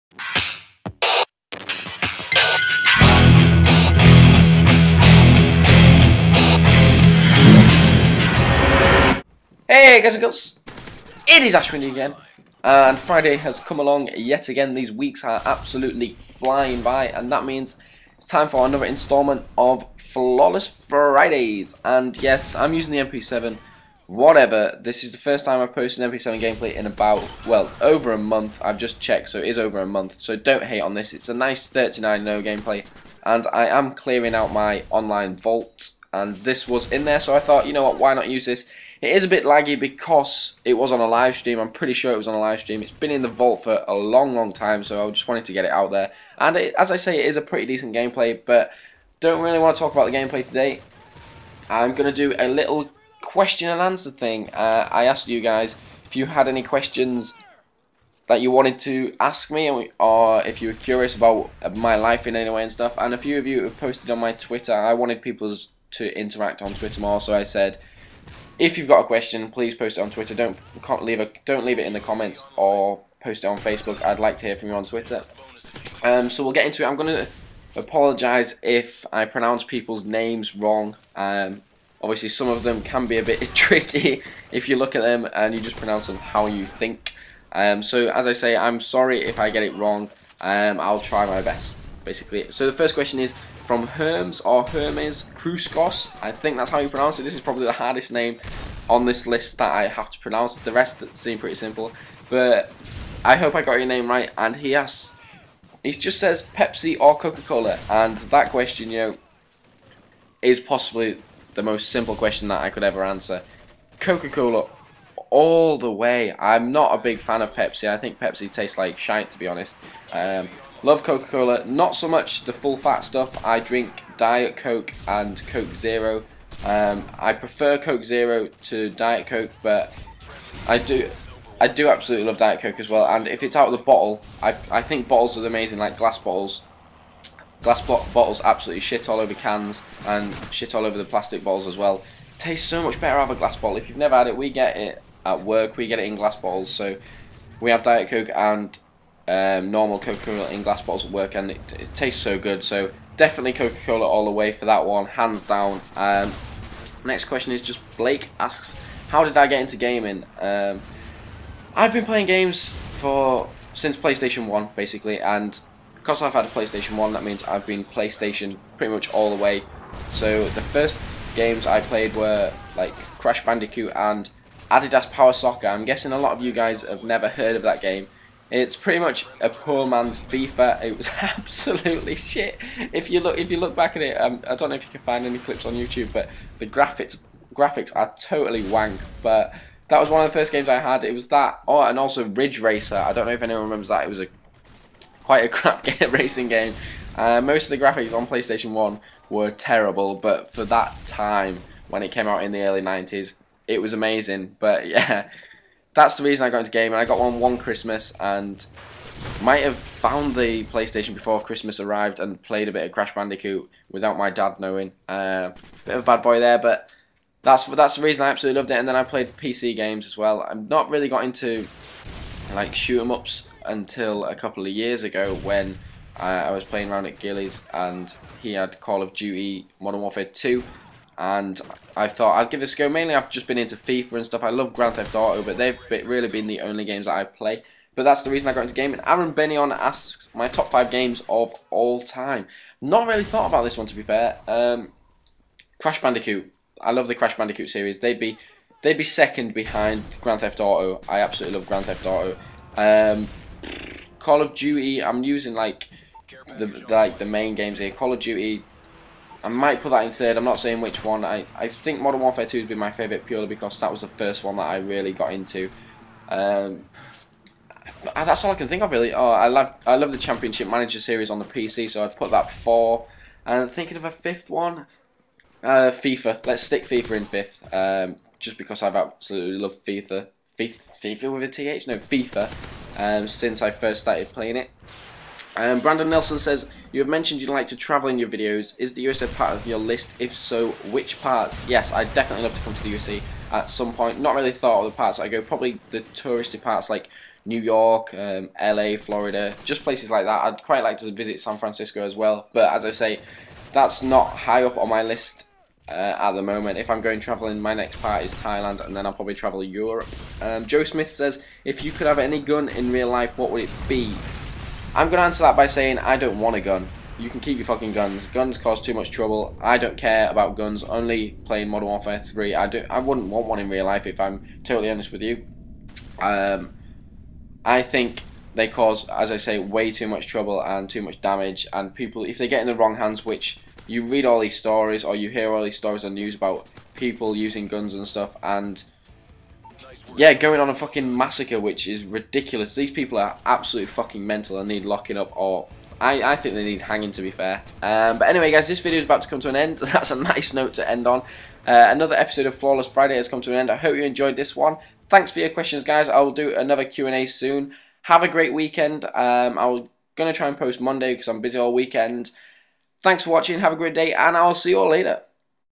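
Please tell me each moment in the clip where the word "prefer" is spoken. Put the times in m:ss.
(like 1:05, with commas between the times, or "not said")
2:07.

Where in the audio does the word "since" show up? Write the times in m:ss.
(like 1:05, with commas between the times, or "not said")
2:43, 4:43.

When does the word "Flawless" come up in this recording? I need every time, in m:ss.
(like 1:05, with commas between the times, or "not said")
0:19, 5:52.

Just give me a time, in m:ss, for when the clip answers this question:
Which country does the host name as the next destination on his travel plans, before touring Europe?
5:08.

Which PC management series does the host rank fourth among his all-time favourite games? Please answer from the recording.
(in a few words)
Championship Manager.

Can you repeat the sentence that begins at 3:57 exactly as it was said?
But that's the reason I got into gaming.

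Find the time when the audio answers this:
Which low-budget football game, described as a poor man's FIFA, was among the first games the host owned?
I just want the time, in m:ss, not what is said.
2:54.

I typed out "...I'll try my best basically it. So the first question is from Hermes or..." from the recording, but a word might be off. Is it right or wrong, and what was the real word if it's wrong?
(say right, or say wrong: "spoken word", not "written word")
right.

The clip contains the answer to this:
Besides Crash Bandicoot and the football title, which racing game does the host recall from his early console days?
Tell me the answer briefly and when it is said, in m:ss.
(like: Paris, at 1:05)
Ridge Racer, at 3:12.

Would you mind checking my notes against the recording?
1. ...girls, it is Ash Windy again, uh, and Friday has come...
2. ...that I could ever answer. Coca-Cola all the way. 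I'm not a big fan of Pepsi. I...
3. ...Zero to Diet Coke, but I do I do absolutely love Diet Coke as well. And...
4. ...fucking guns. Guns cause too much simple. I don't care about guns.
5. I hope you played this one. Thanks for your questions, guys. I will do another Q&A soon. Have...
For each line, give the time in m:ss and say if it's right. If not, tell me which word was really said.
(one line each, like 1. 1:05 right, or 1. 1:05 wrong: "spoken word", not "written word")
1. 0:10 right
2. 1:52 right
3. 2:08 right
4. 5:17 wrong: "trouble", not "simple"
5. 5:53 wrong: "enjoyed", not "played".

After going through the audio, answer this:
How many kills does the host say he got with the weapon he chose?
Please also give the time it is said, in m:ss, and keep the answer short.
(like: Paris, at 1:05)
39, at 0:31.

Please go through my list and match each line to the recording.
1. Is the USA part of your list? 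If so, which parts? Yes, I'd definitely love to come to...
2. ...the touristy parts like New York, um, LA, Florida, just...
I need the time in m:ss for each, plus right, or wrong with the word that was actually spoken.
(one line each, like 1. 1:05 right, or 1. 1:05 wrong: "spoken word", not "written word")
1. 4:48 right
2. 4:55 right.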